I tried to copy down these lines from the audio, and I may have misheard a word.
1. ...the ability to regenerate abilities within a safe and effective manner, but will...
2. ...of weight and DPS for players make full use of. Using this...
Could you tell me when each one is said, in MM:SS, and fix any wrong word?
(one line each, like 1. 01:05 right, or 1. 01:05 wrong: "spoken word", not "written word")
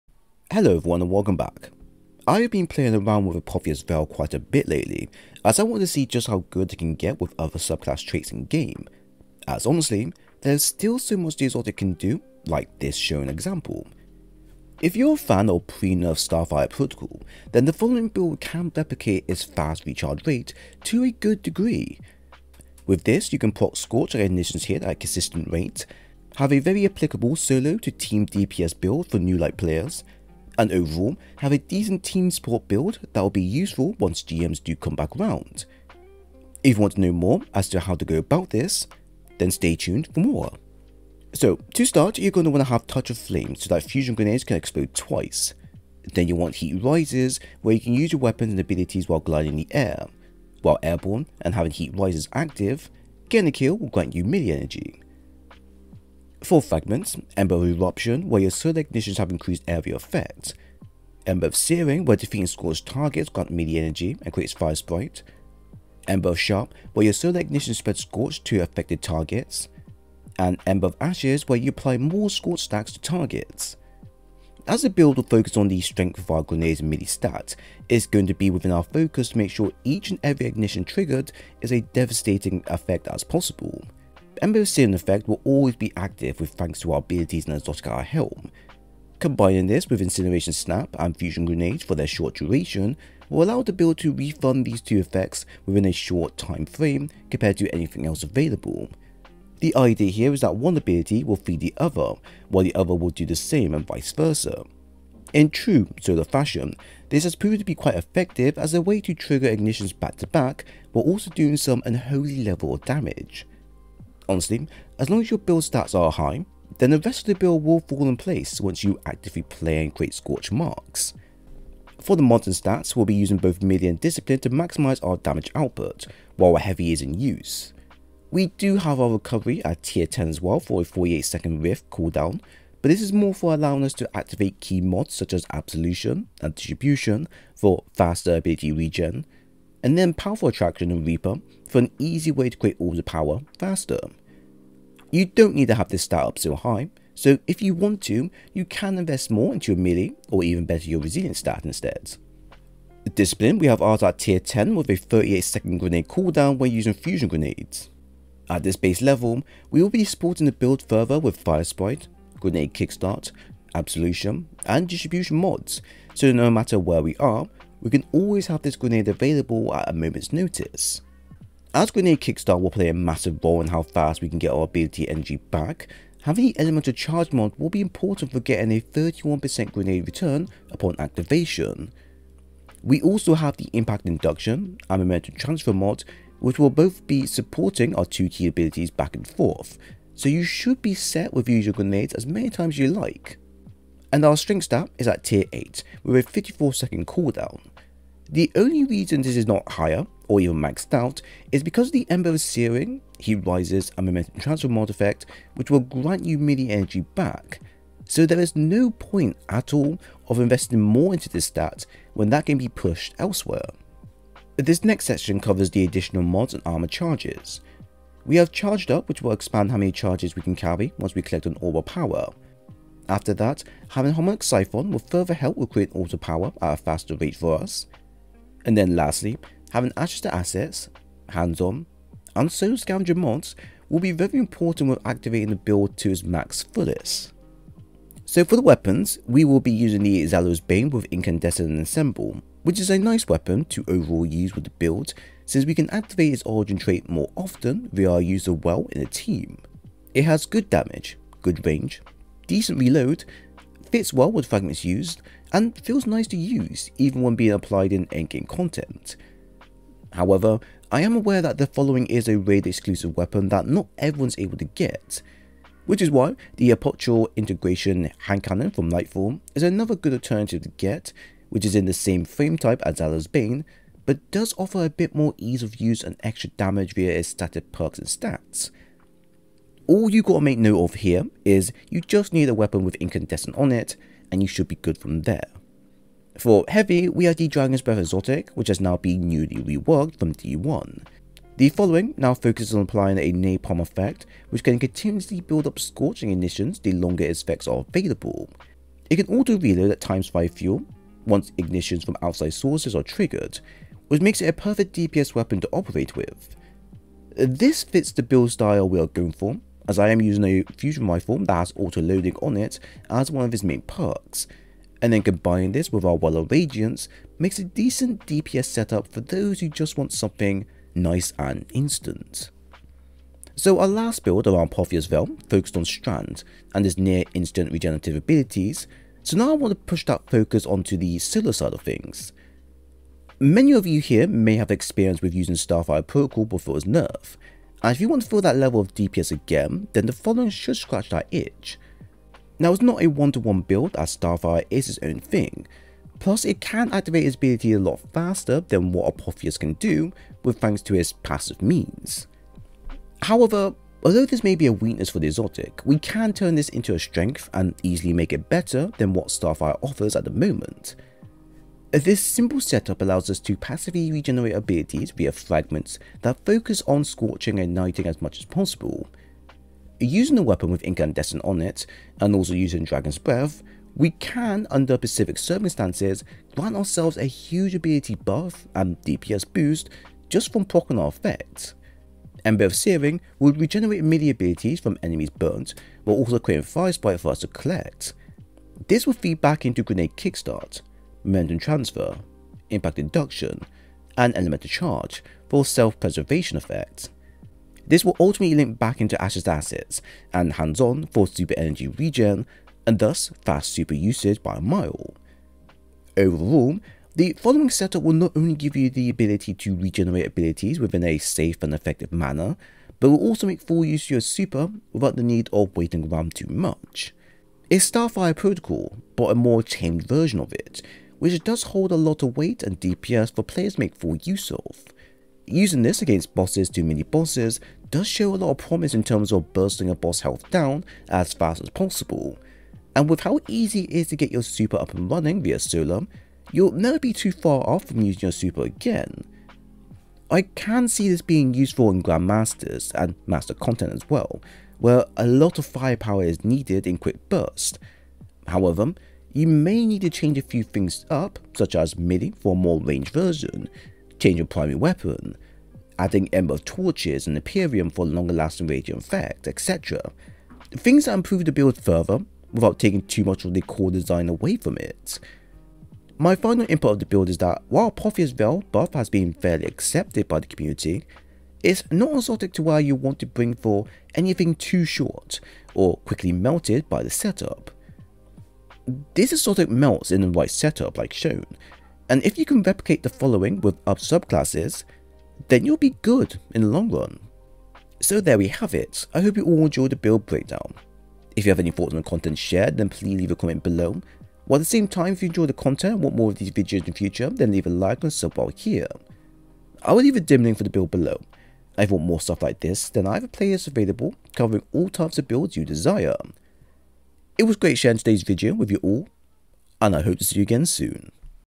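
1. 06:48 right
2. 07:02 right.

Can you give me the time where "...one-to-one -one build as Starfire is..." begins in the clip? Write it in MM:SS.
05:43.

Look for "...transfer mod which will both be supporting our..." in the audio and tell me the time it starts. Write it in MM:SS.
03:05.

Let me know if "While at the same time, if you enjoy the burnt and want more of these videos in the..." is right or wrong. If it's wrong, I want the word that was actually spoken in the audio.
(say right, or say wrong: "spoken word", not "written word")
wrong: "content", not "burnt".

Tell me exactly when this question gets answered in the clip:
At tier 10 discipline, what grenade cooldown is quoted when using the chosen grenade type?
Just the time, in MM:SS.
02:34.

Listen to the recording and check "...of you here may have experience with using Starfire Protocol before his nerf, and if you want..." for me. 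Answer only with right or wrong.
right.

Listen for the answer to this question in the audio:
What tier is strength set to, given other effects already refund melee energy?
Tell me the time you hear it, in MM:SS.
03:15.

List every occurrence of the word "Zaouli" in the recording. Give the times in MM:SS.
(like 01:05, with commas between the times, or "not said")
04:00, 04:32.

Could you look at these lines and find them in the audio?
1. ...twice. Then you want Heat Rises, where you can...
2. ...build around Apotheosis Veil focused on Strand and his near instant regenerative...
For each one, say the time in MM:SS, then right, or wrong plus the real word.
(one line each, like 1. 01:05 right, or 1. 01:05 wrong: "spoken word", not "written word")
1. 00:44 right
2. 05:24 right.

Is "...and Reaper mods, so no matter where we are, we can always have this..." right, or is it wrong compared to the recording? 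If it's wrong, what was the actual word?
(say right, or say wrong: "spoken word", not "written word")
wrong: "Distribution", not "Reaper".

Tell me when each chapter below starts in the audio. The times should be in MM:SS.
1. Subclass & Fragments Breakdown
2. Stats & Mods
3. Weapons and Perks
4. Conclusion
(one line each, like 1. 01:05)
1. 00:40
2. 02:01
3. 03:57
4. 05:22.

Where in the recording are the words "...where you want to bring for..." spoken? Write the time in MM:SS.
07:52.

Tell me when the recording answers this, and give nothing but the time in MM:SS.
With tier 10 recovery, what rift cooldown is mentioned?
02:10.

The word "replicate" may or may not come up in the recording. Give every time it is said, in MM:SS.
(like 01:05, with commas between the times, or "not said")
00:18, 08:02.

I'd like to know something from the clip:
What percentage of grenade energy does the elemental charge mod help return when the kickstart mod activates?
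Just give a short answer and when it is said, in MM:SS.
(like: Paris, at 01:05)
31%, at 02:58.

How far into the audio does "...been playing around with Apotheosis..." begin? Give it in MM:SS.
00:02.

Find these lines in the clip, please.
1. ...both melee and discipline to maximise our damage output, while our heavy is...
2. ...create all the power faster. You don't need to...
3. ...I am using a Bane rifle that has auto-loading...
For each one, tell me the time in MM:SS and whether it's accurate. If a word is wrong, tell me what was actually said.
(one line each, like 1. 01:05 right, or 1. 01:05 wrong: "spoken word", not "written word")
1. 02:03 right
2. 02:22 right
3. 05:09 wrong: "Fusion", not "Bane".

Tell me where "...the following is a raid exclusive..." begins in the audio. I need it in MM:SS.
04:21.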